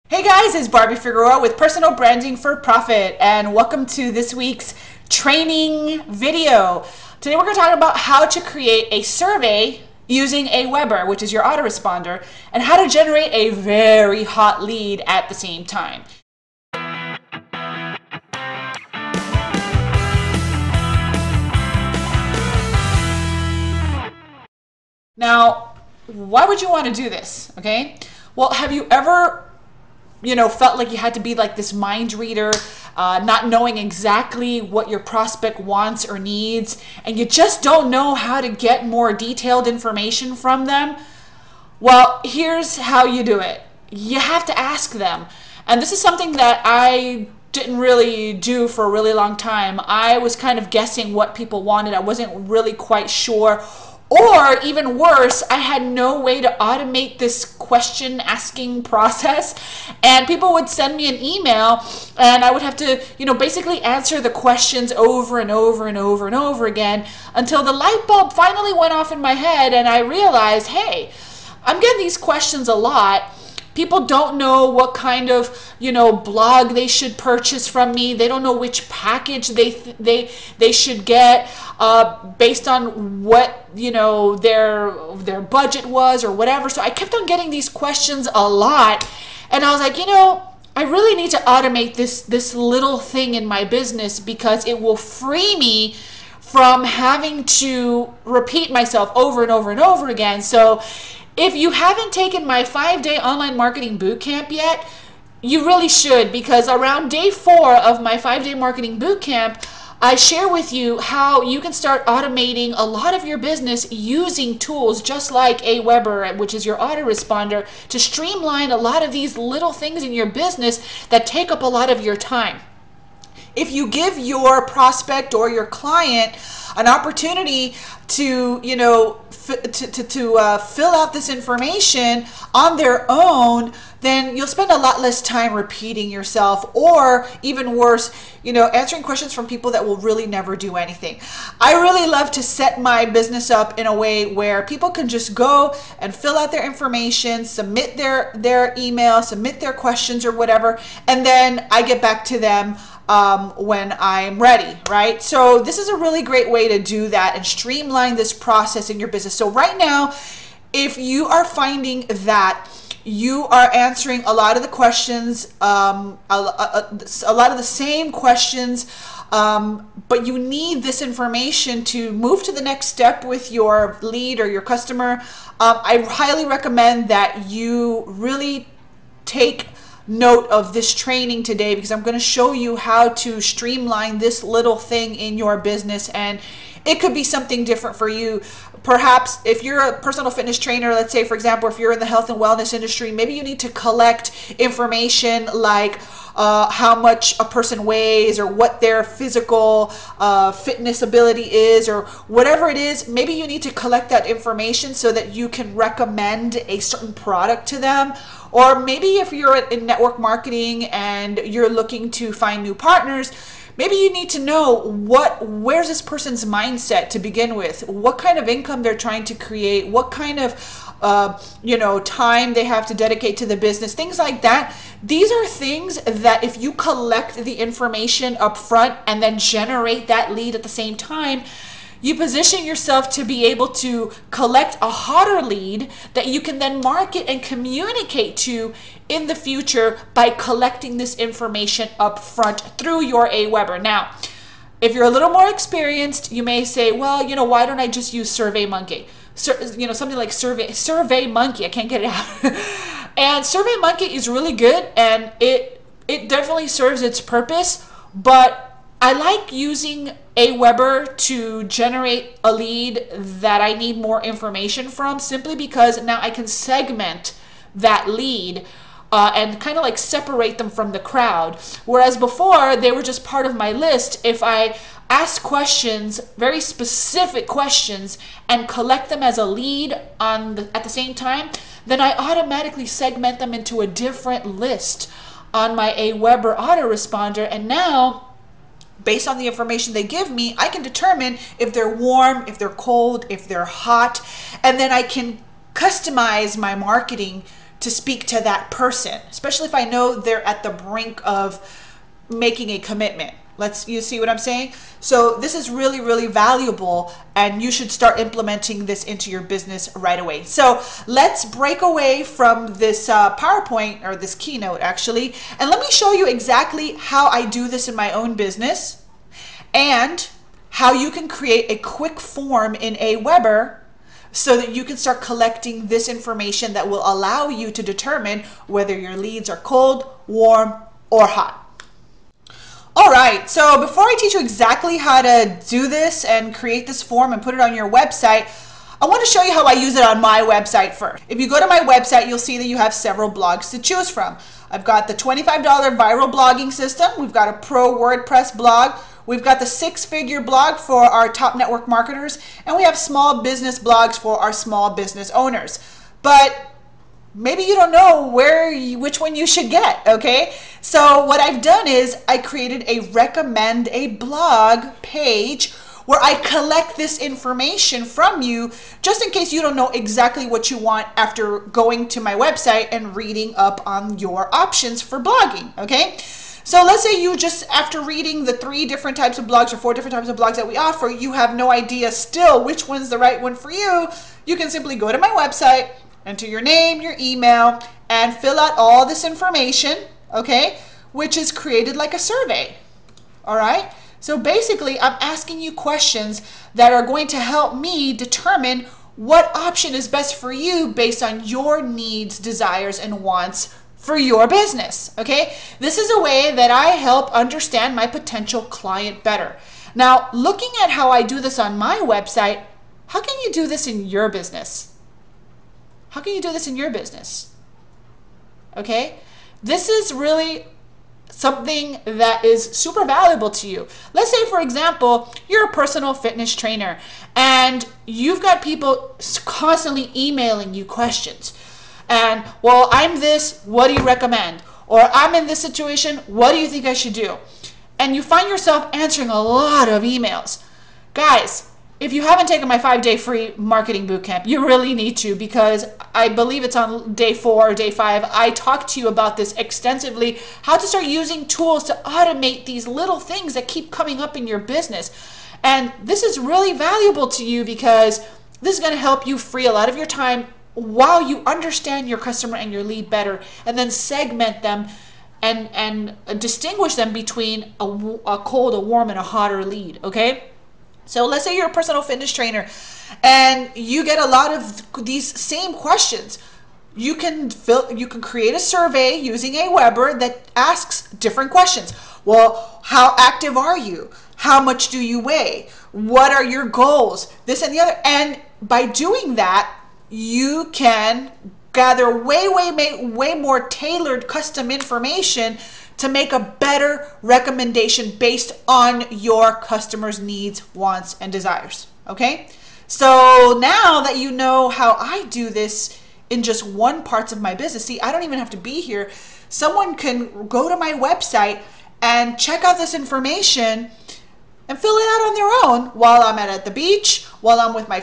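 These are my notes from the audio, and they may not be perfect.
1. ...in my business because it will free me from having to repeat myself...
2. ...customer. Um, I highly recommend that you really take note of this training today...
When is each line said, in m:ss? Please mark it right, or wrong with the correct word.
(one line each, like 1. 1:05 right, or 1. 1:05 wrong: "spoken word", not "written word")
1. 1:33 right
2. 2:54 right.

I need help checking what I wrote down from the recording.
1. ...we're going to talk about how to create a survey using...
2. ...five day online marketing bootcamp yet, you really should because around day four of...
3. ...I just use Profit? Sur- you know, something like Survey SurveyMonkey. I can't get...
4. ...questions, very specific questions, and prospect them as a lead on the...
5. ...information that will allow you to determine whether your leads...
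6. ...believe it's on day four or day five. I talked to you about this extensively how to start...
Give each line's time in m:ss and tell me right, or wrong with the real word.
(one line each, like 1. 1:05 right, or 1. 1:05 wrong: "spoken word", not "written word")
1. 0:07 right
2. 1:42 right
3. 4:07 wrong: "SurveyMonkey", not "Profit"
4. 4:35 wrong: "collect", not "prospect"
5. 5:26 right
6. 7:26 right.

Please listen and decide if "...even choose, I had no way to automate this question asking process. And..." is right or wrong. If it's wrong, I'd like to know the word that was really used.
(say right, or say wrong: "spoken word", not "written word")
wrong: "worse", not "choose".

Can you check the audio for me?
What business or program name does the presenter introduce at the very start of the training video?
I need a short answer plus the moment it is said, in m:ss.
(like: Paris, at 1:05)
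Personal Branding for Profit, at 0:01.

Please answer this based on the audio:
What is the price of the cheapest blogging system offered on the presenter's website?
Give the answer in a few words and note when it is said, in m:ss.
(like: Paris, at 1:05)
$25, at 5:45.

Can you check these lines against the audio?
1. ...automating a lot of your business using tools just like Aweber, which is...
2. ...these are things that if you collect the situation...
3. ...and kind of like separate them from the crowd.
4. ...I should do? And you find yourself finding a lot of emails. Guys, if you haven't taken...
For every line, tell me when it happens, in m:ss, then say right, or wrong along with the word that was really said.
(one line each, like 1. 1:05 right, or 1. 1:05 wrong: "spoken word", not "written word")
1. 1:52 right
2. 3:45 wrong: "information", not "situation"
3. 4:29 right
4. 7:16 wrong: "answering", not "finding".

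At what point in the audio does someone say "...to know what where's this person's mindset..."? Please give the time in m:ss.
3:34.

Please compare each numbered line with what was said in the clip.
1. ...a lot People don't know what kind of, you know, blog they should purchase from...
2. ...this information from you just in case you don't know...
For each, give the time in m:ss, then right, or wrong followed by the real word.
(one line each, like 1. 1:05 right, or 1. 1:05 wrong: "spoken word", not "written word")
1. 1:12 right
2. 6:06 right.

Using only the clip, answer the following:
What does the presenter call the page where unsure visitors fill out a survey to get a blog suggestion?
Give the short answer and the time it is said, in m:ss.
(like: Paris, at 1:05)
recommend a blog page, at 6:03.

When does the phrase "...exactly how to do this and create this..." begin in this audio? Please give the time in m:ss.
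5:34.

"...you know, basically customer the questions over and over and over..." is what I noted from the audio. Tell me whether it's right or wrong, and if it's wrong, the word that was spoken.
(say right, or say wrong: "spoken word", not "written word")
wrong: "answer", not "customer".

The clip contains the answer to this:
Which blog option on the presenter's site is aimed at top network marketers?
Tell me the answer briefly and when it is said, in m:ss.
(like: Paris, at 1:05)
six figure blog, at 5:49.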